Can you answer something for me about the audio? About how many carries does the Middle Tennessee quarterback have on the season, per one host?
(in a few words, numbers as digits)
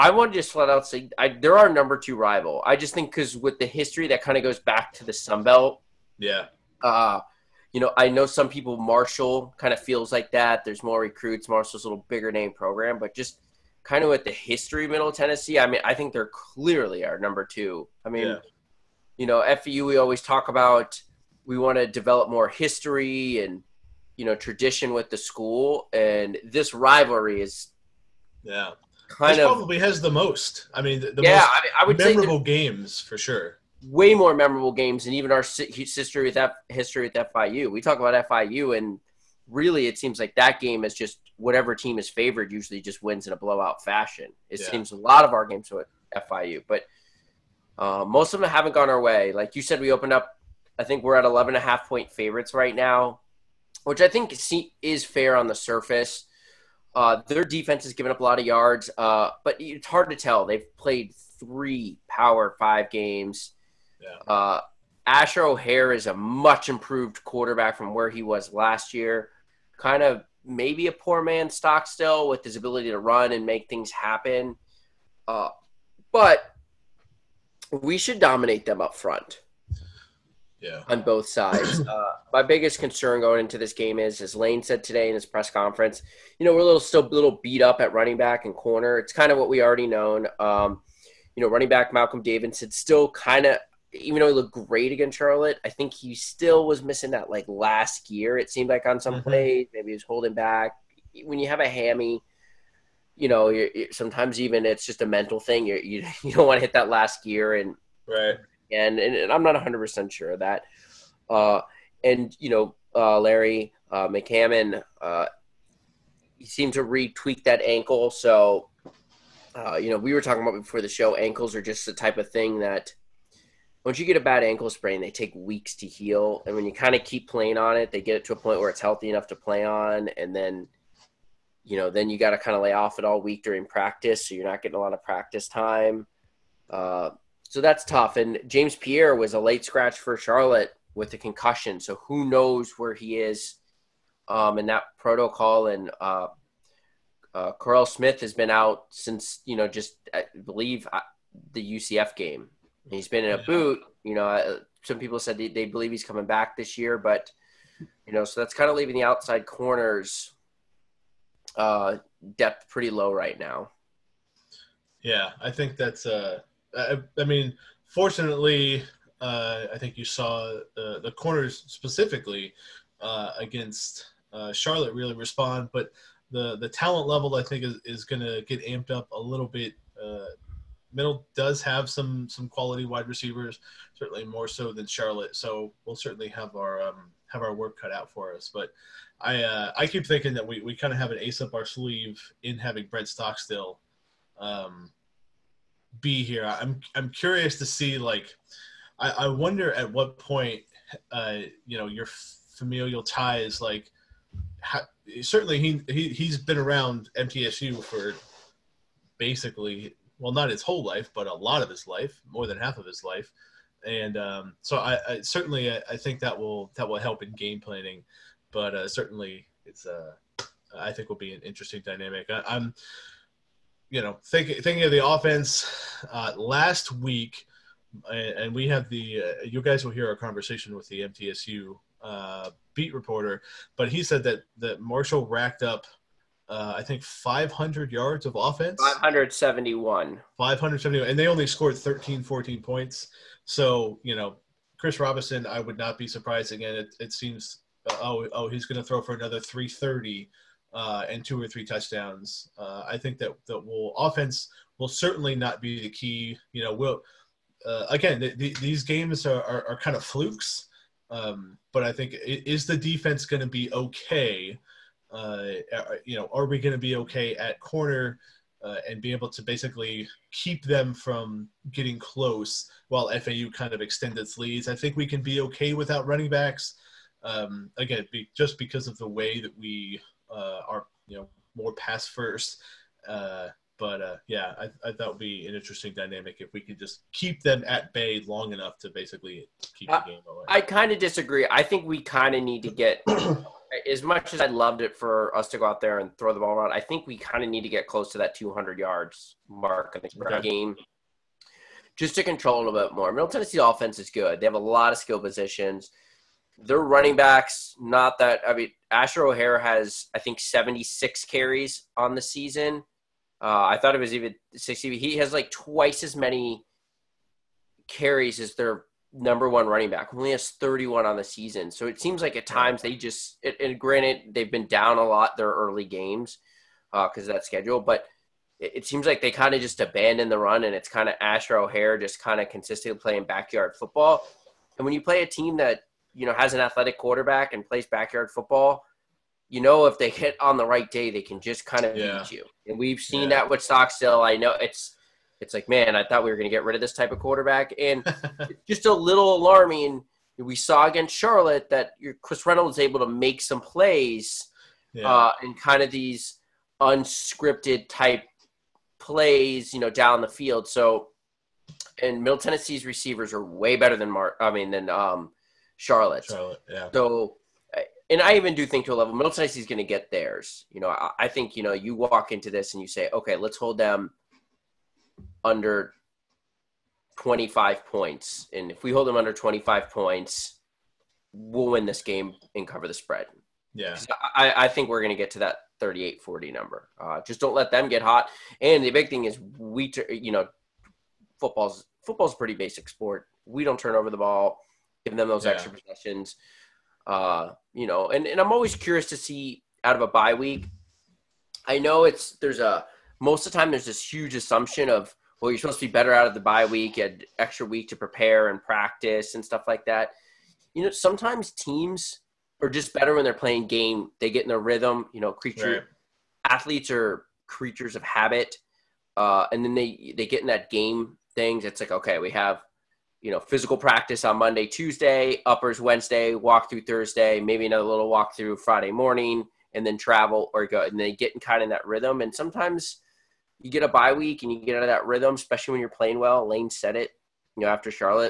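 76.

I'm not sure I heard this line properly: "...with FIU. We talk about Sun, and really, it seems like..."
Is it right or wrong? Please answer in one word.
wrong.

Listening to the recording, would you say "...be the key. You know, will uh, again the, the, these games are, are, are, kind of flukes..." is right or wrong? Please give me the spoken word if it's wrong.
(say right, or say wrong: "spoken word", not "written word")
right.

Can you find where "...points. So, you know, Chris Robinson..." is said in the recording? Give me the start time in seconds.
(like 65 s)
242 s.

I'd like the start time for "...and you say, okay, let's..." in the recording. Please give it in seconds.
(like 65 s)
372 s.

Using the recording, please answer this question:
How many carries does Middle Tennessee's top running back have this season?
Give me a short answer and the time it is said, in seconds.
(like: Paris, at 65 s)
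31, at 320 s.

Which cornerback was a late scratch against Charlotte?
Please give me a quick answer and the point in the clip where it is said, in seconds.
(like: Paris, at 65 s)
James Pierre, at 138 s.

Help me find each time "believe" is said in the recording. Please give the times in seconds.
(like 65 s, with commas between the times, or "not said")
150 s, 155 s.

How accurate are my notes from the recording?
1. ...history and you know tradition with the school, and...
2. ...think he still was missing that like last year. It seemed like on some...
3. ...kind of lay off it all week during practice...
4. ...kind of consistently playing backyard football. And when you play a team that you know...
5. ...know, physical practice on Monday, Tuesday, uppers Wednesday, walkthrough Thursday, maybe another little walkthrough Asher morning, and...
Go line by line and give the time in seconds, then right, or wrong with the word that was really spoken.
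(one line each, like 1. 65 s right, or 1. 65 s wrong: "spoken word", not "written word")
1. 22 s right
2. 95 s right
3. 132 s right
4. 332 s right
5. 423 s wrong: "Friday", not "Asher".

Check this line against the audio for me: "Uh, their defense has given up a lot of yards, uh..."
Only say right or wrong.
right.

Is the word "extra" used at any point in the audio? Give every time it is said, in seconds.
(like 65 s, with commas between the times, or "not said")
395 s, 407 s.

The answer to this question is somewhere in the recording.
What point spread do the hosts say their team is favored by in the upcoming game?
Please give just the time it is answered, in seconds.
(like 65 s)
51 s.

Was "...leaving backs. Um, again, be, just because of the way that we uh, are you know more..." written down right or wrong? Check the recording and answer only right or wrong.
wrong.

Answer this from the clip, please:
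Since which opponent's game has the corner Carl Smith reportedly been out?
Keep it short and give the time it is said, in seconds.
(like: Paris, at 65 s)
UCF, at 151 s.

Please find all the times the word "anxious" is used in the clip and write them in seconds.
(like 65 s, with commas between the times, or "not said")
not said.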